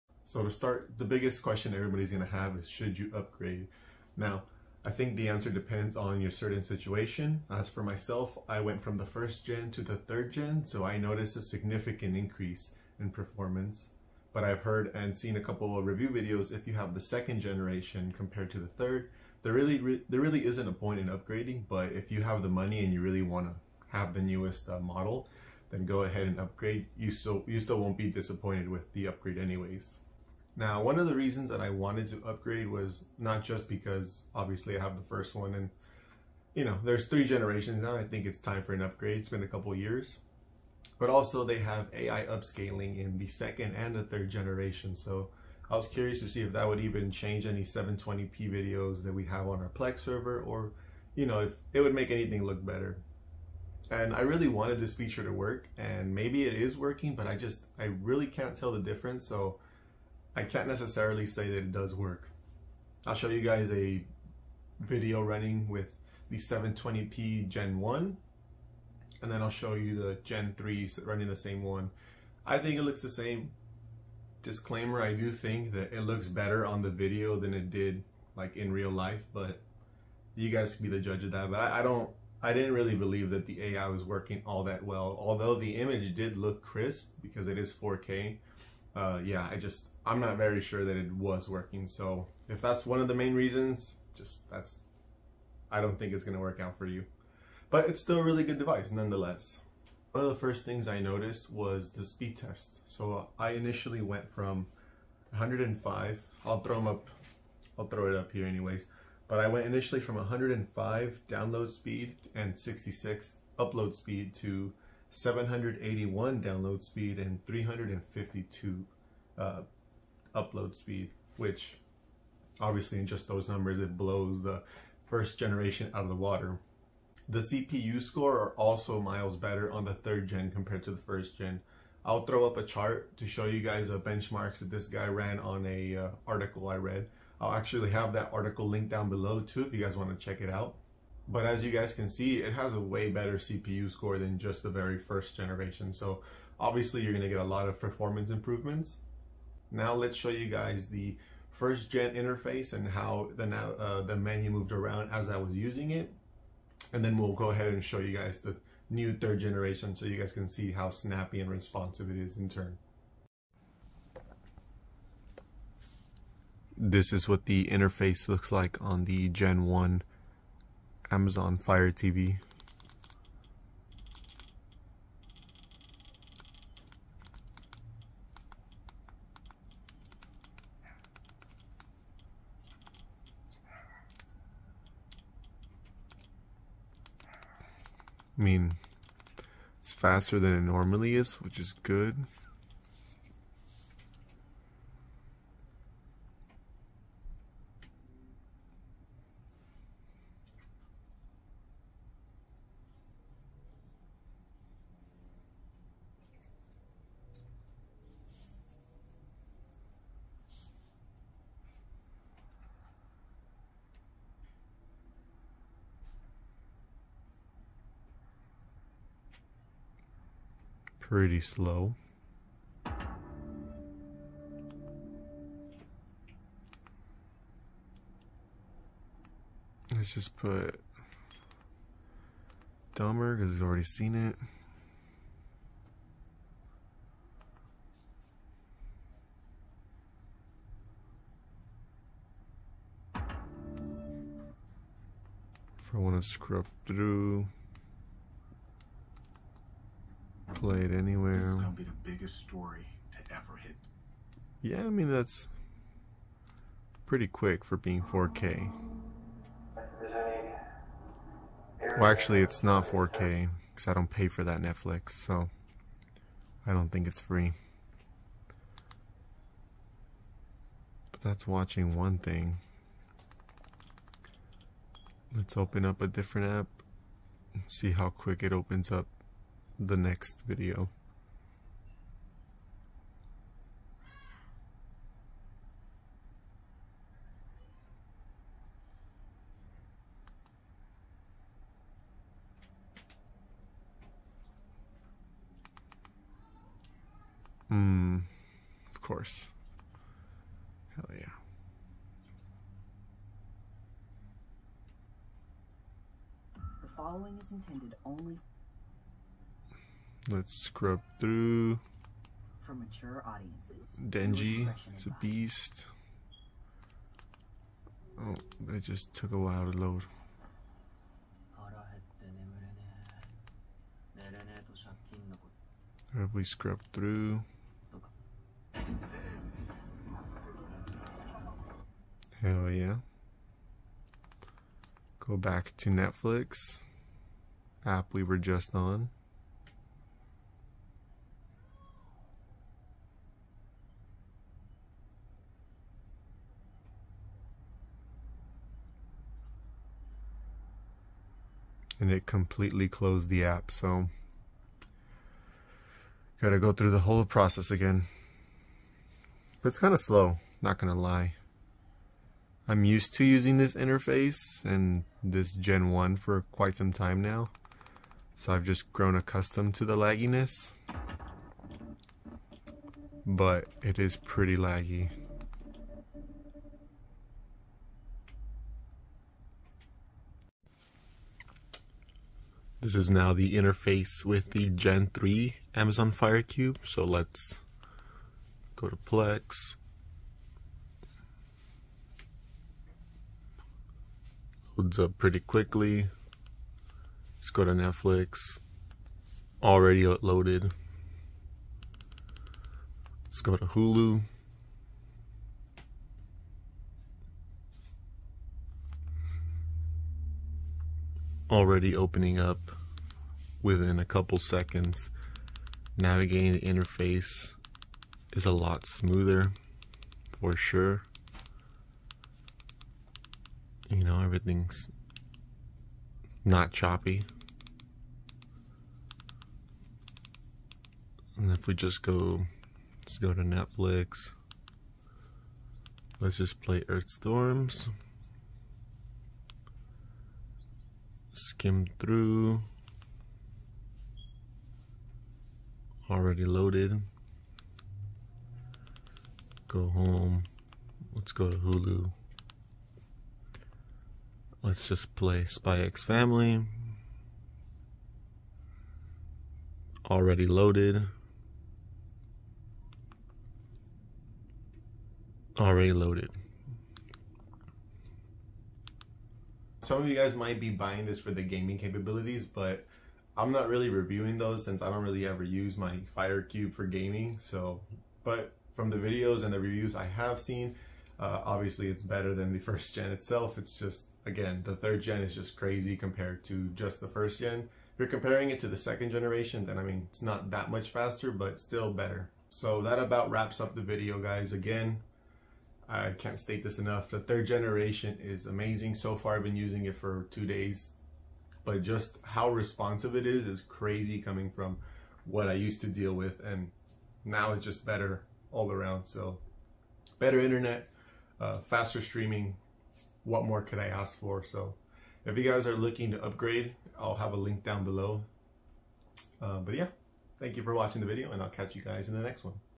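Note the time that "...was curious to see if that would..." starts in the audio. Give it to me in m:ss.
0:45.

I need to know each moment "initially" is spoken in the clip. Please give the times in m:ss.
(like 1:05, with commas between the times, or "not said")
1:43, 1:49.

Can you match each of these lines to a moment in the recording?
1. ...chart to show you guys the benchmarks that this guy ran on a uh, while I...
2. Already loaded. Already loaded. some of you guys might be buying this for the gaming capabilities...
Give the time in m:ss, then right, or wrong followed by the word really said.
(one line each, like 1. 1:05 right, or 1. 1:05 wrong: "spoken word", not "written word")
1. 2:12 wrong: "article", not "while"
2. 7:40 right.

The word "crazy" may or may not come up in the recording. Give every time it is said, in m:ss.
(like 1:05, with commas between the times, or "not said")
8:05, 8:23.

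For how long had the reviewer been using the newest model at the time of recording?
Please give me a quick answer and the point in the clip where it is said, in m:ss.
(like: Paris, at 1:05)
2 days, at 8:20.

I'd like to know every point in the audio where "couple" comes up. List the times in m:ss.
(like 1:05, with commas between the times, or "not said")
0:15, 0:39, 6:54.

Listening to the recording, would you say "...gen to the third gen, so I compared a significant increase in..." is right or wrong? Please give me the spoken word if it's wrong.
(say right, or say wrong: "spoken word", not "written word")
wrong: "noticed", not "compared".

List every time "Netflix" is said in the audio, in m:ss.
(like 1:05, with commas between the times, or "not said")
4:24, 5:35, 6:37, 7:13.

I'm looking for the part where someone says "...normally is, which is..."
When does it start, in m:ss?
3:10.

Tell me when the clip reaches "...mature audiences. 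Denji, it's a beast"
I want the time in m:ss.
5:12.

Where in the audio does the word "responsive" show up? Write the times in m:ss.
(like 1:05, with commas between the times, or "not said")
2:41, 8:22.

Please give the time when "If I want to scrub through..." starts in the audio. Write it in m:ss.
4:05.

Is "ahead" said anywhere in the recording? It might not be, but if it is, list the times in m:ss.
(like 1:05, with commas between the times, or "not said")
0:26, 2:37.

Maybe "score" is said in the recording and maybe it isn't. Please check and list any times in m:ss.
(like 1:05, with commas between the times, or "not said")
2:08, 2:23.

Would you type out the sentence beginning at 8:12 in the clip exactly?
So that about wraps up the video, guys.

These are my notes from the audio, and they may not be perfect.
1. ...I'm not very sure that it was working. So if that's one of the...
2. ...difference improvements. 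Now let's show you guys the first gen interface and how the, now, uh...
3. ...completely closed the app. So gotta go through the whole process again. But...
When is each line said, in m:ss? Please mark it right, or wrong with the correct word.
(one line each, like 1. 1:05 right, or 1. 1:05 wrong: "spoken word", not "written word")
1. 1:30 right
2. 2:27 wrong: "performance", not "difference"
3. 5:52 right.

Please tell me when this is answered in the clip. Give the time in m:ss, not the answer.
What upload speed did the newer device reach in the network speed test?
1:57.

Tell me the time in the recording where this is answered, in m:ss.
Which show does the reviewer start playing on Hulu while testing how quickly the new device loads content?
7:35.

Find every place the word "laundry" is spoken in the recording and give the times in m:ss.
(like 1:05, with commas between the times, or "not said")
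not said.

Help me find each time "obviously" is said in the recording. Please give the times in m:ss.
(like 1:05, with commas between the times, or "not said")
0:34, 2:02, 2:26, 8:01.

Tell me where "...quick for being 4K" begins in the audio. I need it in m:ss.
4:17.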